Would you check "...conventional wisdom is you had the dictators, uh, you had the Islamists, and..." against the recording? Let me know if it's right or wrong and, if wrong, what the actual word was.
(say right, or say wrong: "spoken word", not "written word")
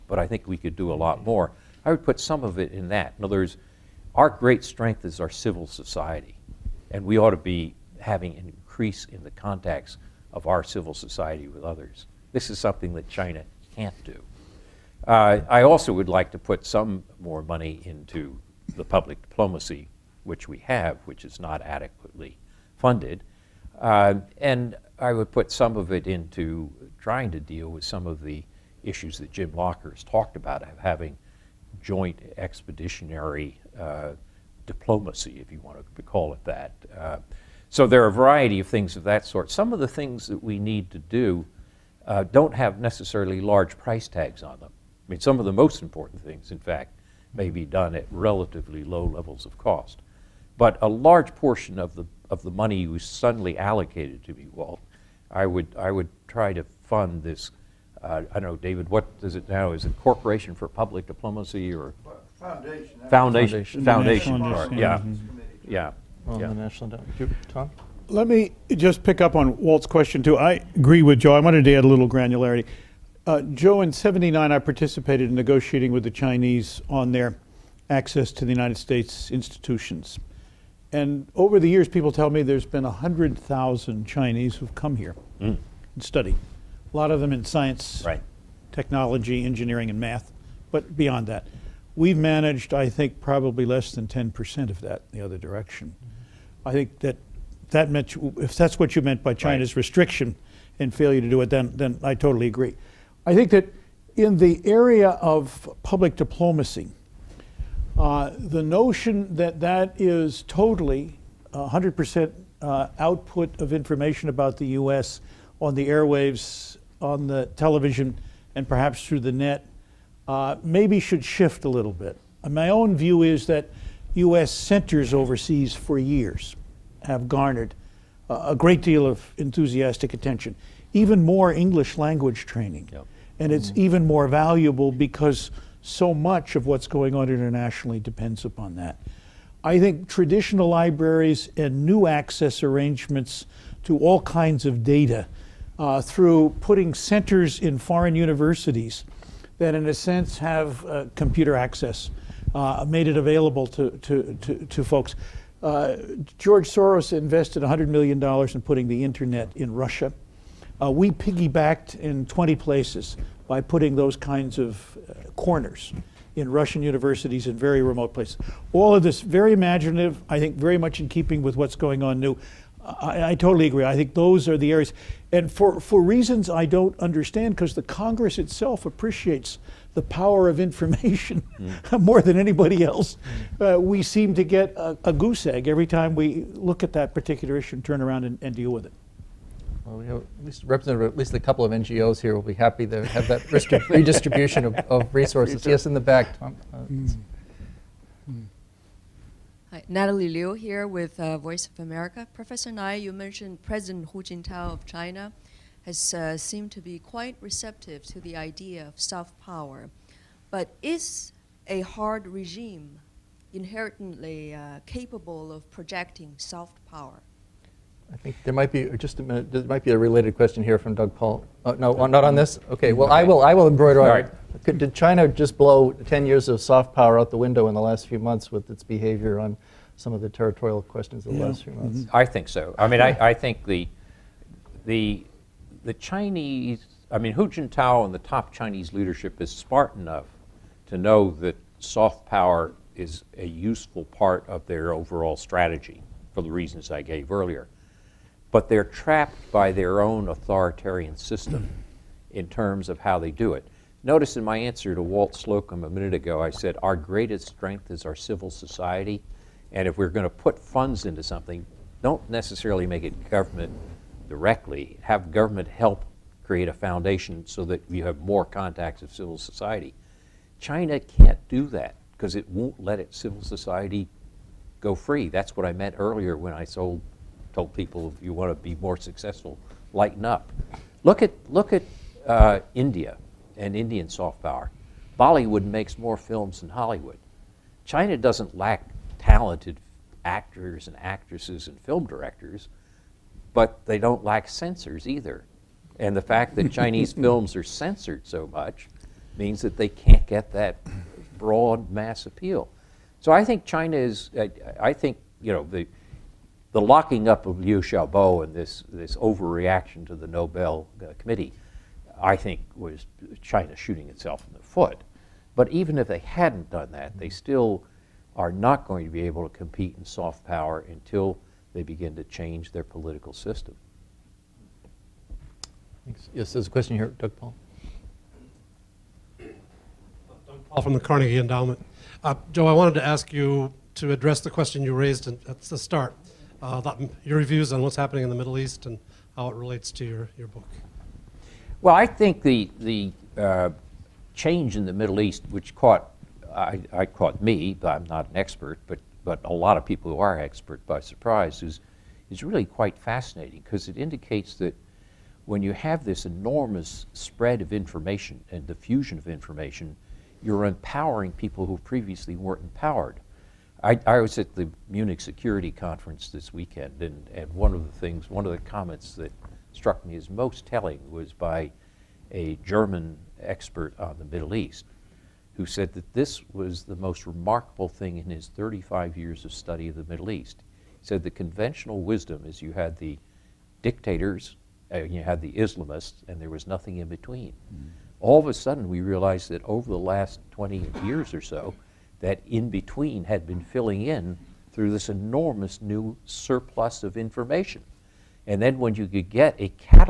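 right.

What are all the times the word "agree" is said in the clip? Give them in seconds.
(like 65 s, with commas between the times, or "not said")
70 s, 102 s, 173 s.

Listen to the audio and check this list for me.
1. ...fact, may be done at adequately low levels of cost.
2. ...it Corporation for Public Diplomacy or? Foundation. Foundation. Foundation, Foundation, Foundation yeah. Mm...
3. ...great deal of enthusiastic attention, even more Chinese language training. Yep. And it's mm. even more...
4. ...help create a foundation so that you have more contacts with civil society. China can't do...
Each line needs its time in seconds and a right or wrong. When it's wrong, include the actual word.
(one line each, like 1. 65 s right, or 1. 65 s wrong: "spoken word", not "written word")
1. 46 s wrong: "relatively", not "adequately"
2. 59 s right
3. 128 s wrong: "English", not "Chinese"
4. 265 s right.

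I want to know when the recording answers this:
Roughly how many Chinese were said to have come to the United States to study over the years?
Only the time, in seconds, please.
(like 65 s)
82 s.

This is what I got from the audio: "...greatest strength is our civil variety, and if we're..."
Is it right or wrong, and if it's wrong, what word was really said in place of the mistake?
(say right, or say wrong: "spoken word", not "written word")
wrong: "society", not "variety".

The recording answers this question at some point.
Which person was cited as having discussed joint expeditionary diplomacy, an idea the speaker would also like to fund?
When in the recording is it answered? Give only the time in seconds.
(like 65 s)
29 s.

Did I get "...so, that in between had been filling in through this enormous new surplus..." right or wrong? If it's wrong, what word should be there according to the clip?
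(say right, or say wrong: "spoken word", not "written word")
right.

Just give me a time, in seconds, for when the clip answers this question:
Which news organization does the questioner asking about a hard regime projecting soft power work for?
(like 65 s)
201 s.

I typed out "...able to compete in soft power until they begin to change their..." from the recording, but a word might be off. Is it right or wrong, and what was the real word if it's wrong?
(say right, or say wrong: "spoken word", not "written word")
right.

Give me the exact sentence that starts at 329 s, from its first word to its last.
Doug Paal from the Carnegie Endowment.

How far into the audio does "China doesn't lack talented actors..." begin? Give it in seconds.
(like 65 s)
287 s.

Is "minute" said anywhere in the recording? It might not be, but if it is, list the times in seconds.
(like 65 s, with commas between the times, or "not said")
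219 s, 255 s.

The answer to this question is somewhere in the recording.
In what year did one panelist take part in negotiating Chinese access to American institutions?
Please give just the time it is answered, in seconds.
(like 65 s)
73 s.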